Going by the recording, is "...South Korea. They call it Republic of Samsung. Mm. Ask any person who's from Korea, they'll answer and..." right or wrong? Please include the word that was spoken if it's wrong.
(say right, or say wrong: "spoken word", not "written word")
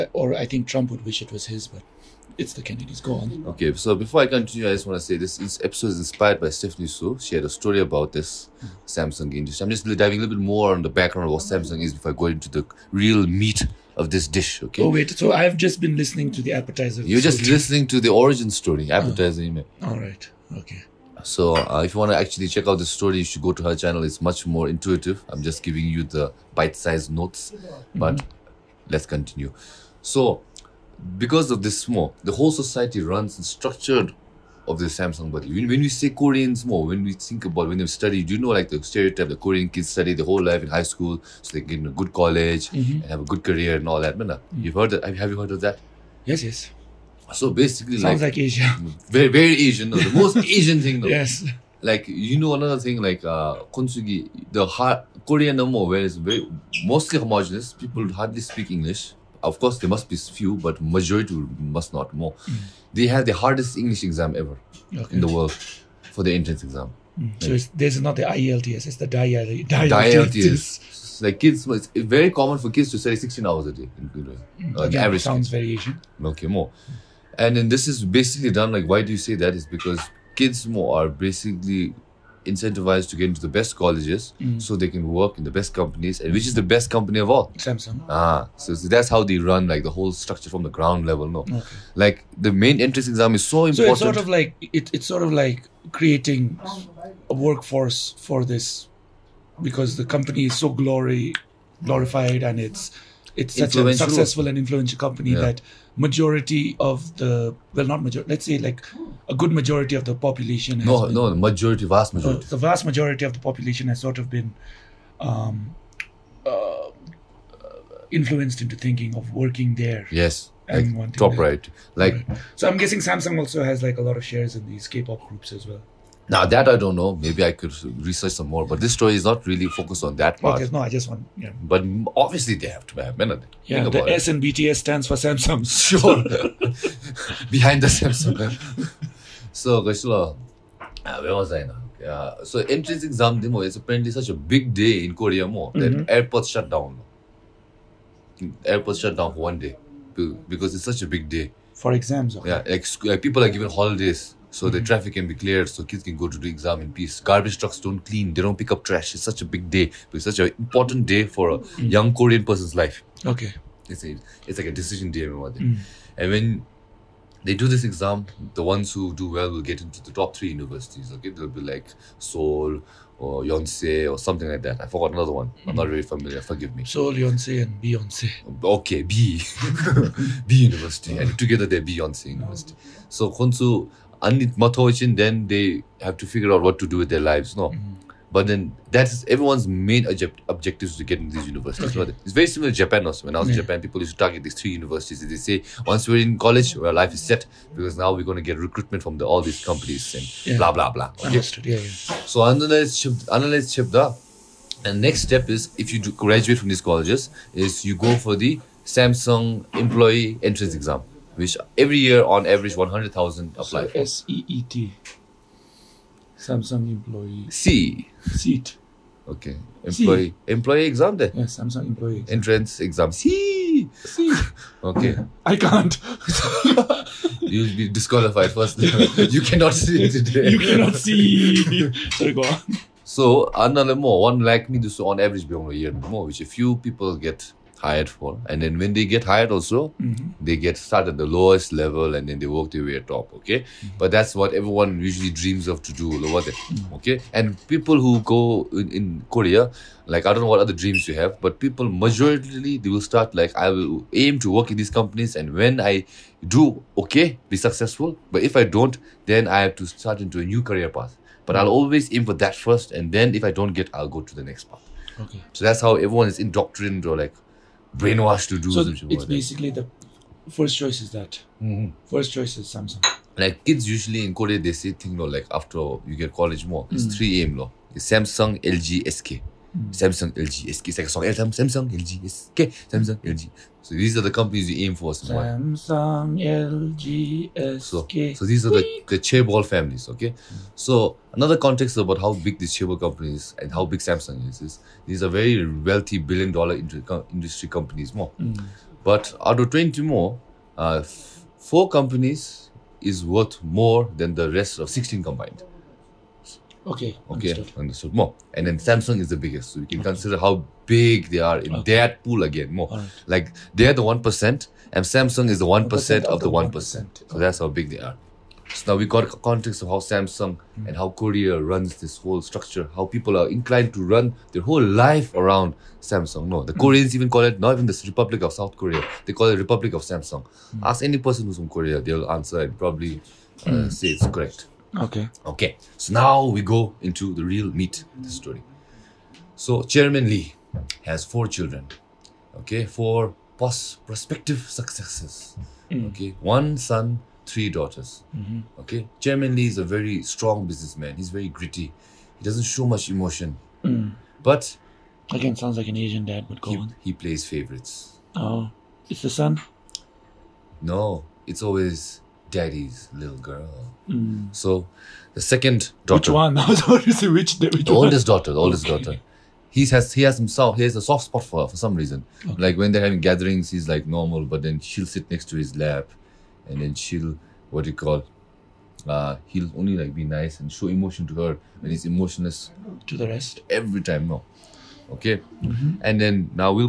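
right.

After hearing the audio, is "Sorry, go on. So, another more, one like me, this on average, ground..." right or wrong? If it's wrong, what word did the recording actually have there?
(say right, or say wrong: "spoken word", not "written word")
wrong: "beyond", not "ground".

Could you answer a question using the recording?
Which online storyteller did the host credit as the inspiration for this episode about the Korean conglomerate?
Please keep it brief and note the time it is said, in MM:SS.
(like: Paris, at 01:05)
Stephanie Soo, at 00:06.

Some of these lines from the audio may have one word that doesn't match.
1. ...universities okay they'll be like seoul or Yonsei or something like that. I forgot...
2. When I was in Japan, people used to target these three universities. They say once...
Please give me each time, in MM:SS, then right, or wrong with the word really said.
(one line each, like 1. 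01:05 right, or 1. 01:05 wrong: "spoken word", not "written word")
1. 02:50 right
2. 03:13 right.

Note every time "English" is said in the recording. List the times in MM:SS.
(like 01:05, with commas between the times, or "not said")
00:58, 01:03.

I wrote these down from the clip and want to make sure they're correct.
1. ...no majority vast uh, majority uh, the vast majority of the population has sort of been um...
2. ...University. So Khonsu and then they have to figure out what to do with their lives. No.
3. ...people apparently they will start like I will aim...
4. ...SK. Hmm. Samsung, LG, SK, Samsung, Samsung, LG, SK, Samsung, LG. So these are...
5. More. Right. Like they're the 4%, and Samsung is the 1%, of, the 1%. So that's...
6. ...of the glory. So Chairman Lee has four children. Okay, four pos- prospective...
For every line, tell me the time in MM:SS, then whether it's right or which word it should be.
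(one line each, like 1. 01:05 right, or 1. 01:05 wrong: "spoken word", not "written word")
1. 01:51 right
2. 03:02 right
3. 04:11 wrong: "majorly", not "apparently"
4. 04:39 right
5. 05:12 wrong: "1", not "4"
6. 05:38 wrong: "story", not "glory".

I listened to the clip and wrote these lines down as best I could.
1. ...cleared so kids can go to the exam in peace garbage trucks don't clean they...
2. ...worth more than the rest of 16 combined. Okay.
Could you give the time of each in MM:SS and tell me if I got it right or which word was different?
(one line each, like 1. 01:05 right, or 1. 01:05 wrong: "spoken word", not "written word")
1. 02:35 right
2. 05:03 right.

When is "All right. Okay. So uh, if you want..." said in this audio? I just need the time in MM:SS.
00:19.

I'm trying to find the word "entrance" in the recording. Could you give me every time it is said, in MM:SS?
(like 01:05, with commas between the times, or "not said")
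01:06, 01:32, 02:22, 03:30, 03:42.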